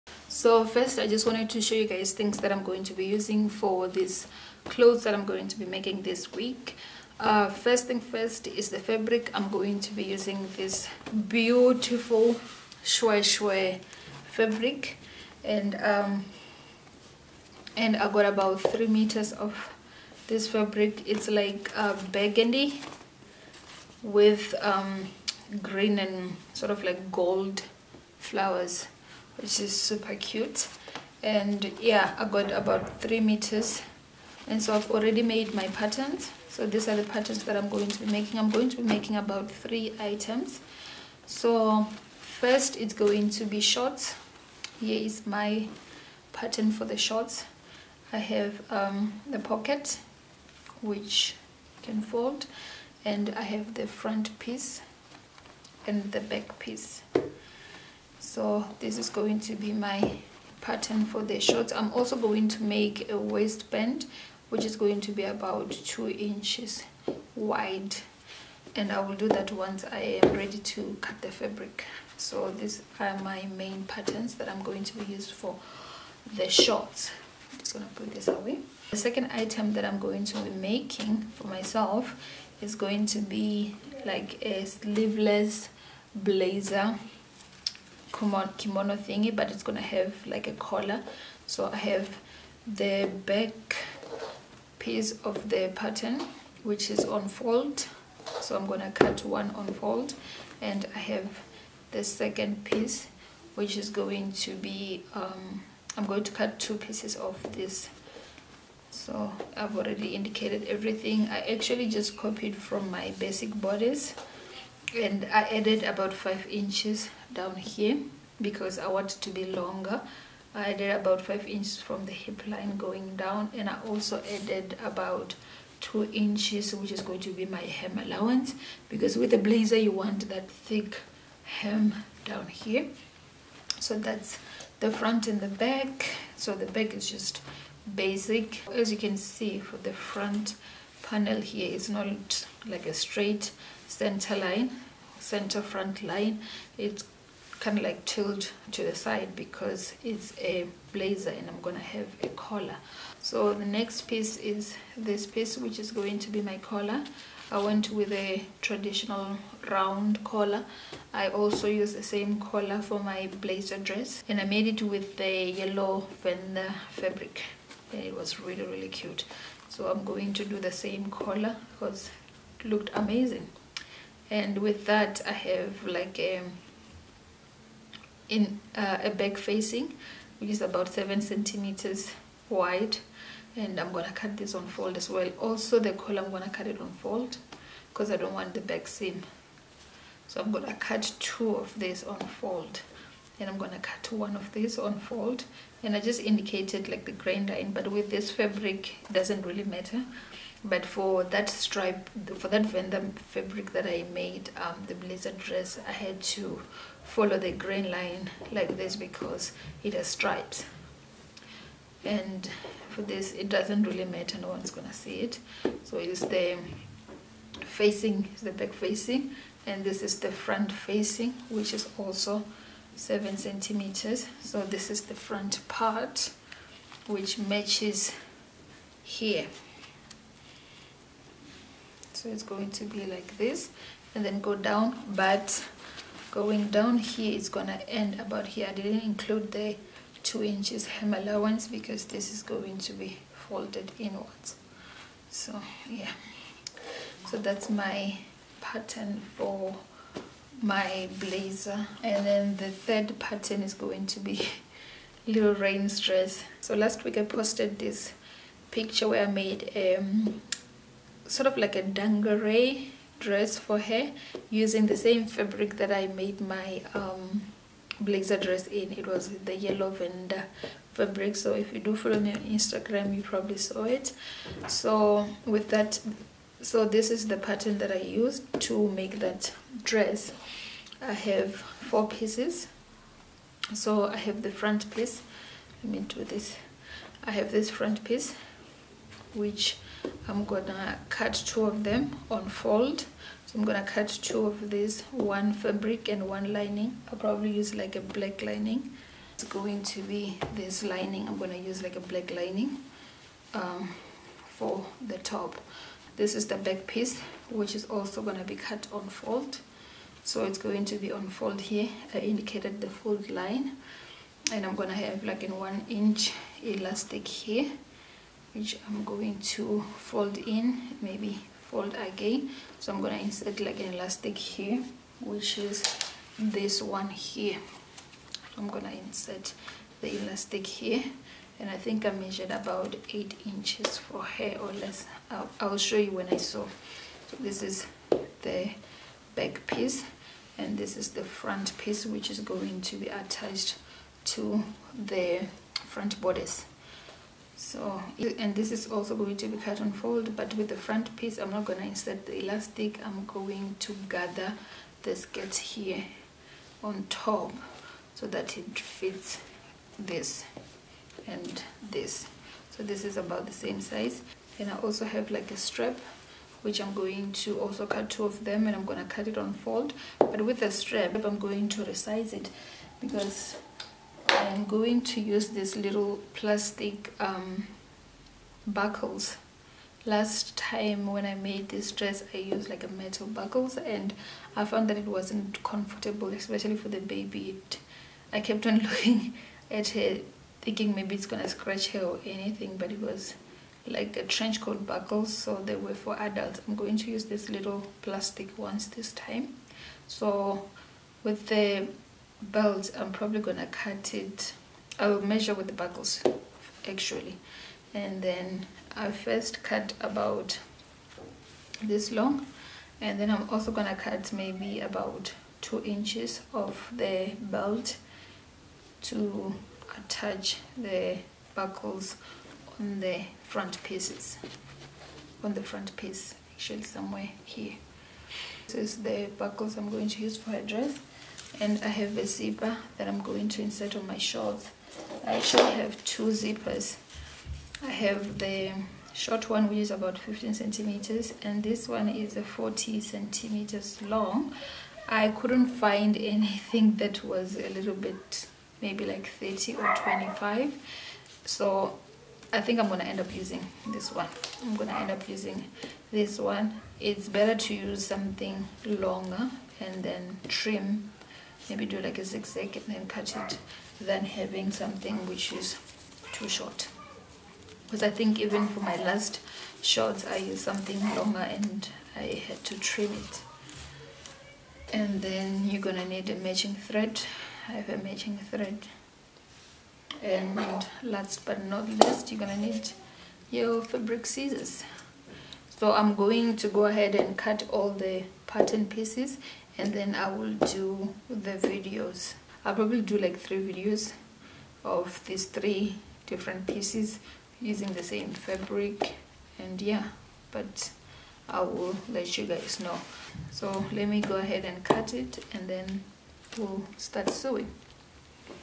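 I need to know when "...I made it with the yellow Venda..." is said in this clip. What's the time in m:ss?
2:44.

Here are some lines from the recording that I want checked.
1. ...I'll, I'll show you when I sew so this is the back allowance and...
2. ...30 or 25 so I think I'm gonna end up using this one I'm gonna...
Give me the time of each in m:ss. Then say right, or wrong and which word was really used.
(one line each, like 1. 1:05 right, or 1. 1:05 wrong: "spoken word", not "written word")
1. 5:35 wrong: "piece", not "allowance"
2. 7:29 right.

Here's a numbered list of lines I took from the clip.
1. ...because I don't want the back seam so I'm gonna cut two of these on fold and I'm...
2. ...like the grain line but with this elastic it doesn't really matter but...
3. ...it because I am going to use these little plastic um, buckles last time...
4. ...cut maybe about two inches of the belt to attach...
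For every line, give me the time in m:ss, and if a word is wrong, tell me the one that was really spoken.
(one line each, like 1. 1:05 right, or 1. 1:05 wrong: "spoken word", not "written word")
1. 3:07 right
2. 3:16 wrong: "fabric", not "elastic"
3. 6:12 right
4. 6:53 right.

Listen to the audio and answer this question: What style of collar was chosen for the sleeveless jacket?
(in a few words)
round collar.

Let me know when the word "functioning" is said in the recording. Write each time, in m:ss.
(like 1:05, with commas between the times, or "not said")
not said.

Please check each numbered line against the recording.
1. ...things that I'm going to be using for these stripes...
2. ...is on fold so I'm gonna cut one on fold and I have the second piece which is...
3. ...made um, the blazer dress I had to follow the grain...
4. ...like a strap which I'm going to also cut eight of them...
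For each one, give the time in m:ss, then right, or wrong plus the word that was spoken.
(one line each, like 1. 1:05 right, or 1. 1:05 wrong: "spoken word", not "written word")
1. 0:02 wrong: "clothes", not "stripes"
2. 1:36 right
3. 3:24 right
4. 6:05 wrong: "two", not "eight".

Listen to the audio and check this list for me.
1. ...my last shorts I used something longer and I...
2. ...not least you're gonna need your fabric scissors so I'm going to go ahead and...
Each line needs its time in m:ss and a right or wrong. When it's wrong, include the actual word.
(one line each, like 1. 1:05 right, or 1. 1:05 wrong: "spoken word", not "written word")
1. 7:48 right
2. 8:01 right.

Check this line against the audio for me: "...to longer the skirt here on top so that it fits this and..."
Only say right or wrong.
wrong.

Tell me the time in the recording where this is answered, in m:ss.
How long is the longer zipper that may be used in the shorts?
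7:22.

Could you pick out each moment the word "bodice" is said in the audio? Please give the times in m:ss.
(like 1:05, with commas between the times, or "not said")
1:53, 5:46.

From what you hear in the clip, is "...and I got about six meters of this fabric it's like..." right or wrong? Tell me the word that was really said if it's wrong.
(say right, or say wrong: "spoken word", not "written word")
wrong: "three", not "six".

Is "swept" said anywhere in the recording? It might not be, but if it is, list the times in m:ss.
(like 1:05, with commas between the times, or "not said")
not said.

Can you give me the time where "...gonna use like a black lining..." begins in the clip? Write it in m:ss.
5:01.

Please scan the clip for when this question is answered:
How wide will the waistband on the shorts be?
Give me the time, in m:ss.
1:05.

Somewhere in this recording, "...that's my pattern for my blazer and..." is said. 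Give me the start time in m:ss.
4:07.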